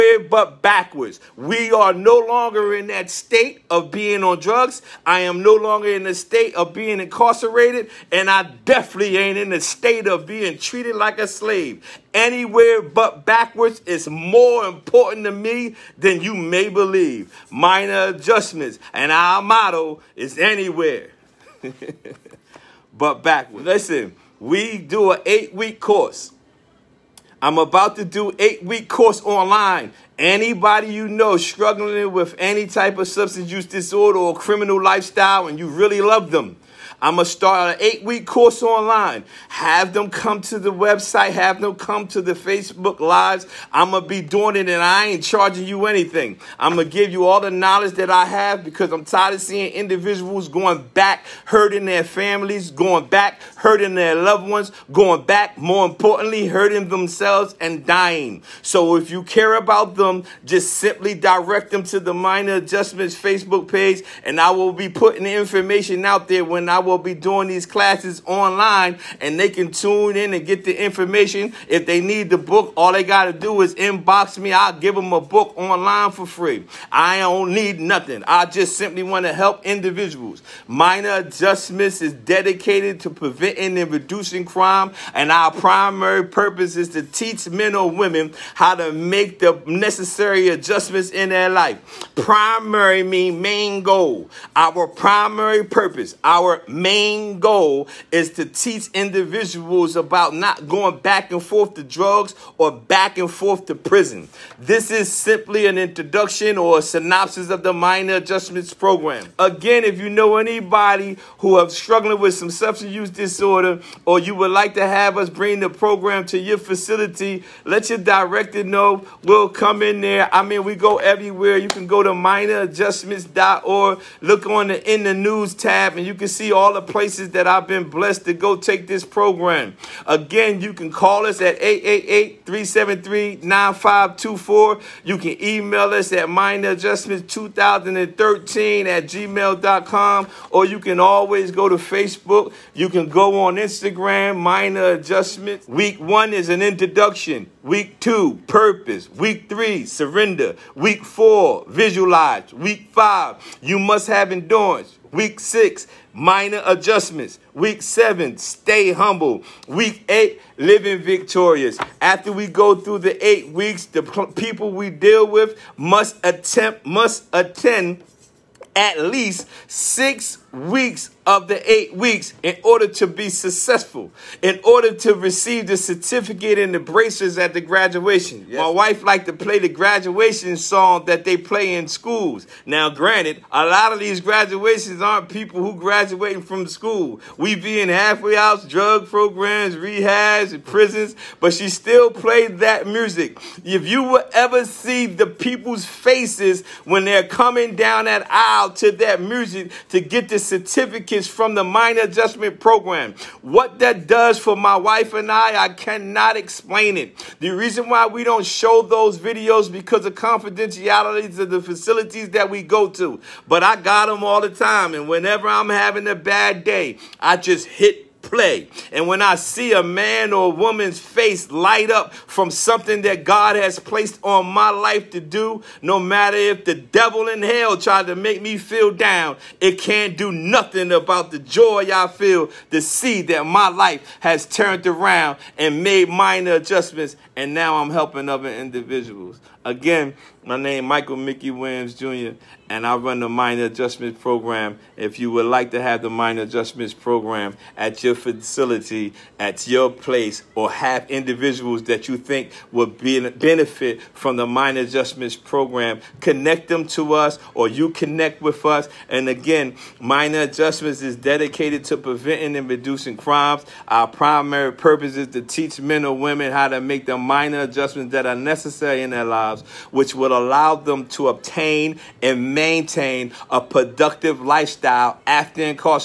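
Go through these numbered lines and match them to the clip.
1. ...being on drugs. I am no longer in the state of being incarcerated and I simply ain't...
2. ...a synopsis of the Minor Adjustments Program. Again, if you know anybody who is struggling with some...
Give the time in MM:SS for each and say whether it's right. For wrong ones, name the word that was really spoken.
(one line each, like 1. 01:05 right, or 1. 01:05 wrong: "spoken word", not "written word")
1. 00:03 wrong: "definitely", not "simply"
2. 01:46 right.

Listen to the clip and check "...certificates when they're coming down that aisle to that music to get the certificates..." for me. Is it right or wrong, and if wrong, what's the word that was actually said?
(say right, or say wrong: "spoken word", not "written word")
wrong: "faces", not "certificates".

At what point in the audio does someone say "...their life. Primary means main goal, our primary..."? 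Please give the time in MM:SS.
01:31.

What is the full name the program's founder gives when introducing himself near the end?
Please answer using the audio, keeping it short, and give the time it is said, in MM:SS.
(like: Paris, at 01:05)
Michael Mickey Williams Jr., at 04:00.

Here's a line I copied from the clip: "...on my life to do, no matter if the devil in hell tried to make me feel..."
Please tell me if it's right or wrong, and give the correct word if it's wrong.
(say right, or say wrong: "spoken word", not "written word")
right.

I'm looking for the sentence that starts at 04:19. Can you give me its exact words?
And again, Minor Adjustments is dedicated to preventing and reducing crimes.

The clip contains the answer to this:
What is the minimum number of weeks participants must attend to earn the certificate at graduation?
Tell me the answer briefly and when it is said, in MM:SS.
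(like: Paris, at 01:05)
6, at 02:49.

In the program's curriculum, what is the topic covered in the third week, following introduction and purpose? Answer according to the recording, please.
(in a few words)
Surrender.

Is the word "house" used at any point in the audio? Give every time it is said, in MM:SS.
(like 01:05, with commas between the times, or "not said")
03:08.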